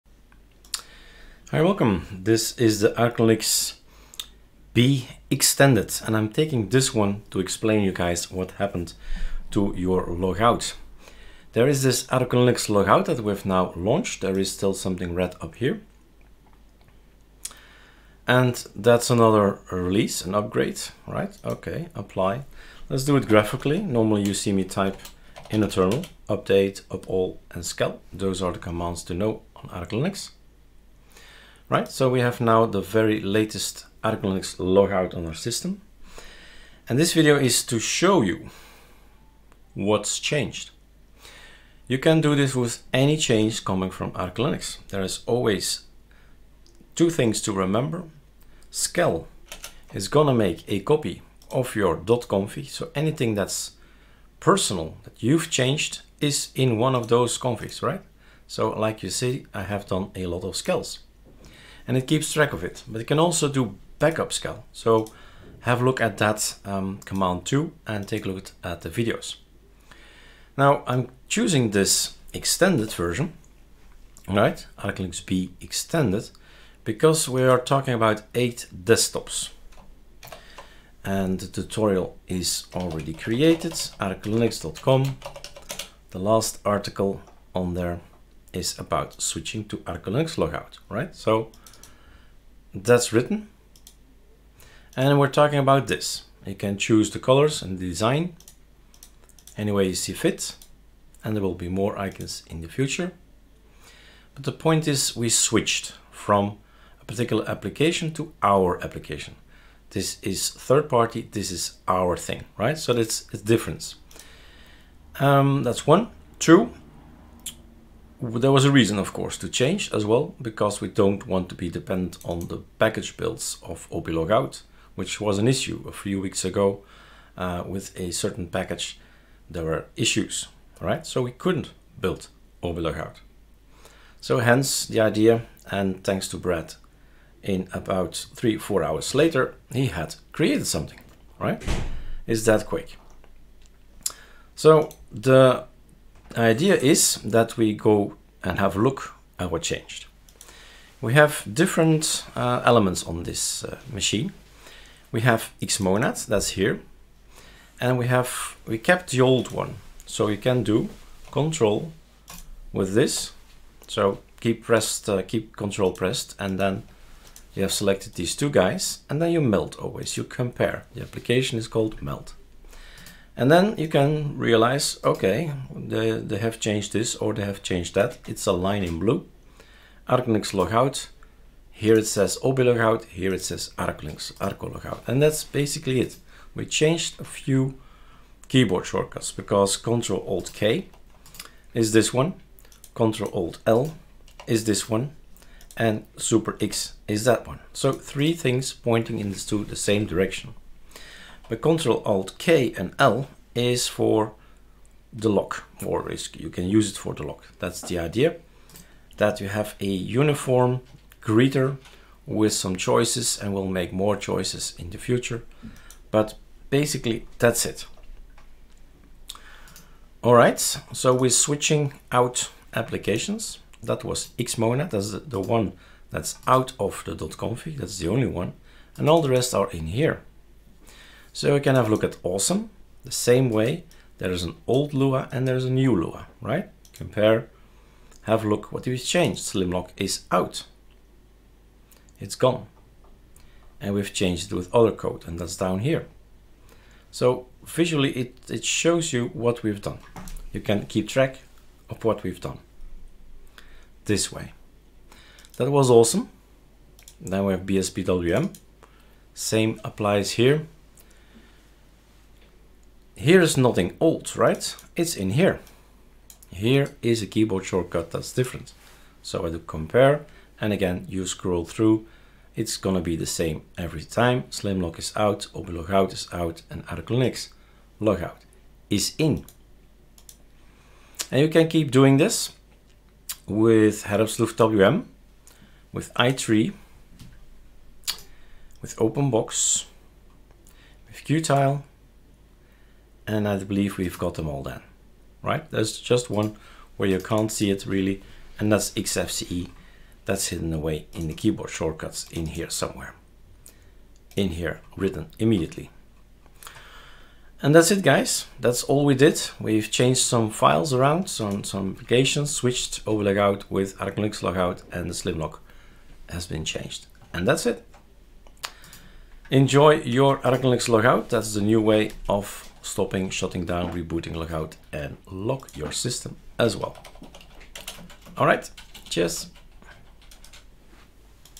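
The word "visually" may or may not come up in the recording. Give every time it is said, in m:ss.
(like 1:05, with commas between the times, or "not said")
4:07.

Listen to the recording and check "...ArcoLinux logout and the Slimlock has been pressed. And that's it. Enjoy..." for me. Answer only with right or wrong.
wrong.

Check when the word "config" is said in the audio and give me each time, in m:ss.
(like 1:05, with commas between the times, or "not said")
0:51, 0:57, 3:47.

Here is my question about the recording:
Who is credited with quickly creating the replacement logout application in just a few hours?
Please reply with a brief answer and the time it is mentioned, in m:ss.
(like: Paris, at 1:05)
Brad, at 2:16.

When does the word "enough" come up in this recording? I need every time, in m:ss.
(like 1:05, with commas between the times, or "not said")
not said.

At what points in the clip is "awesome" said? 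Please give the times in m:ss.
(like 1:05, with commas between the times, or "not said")
3:52, 4:15.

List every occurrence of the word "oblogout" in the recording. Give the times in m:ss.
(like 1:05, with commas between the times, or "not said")
2:03, 2:12.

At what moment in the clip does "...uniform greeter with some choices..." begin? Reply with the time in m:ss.
3:29.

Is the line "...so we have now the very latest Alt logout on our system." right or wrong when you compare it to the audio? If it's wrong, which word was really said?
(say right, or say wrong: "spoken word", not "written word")
wrong: "ArcoLinux", not "Alt".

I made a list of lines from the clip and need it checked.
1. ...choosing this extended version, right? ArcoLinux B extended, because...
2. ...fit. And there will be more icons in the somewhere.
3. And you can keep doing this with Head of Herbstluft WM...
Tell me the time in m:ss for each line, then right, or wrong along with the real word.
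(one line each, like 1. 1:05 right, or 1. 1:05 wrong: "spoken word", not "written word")
1. 1:11 right
2. 1:40 wrong: "future", not "somewhere"
3. 4:41 right.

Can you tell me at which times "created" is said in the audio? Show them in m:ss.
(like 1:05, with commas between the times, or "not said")
1:23, 2:20.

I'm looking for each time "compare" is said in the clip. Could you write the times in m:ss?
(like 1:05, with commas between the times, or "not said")
2:50, 3:56, 4:29.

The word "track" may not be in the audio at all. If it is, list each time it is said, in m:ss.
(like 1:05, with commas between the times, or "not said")
1:02, 4:11.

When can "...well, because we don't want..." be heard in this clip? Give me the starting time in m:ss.
2:00.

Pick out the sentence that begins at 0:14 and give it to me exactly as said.
There is still something red up here.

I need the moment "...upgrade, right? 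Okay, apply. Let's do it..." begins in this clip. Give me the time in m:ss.
0:20.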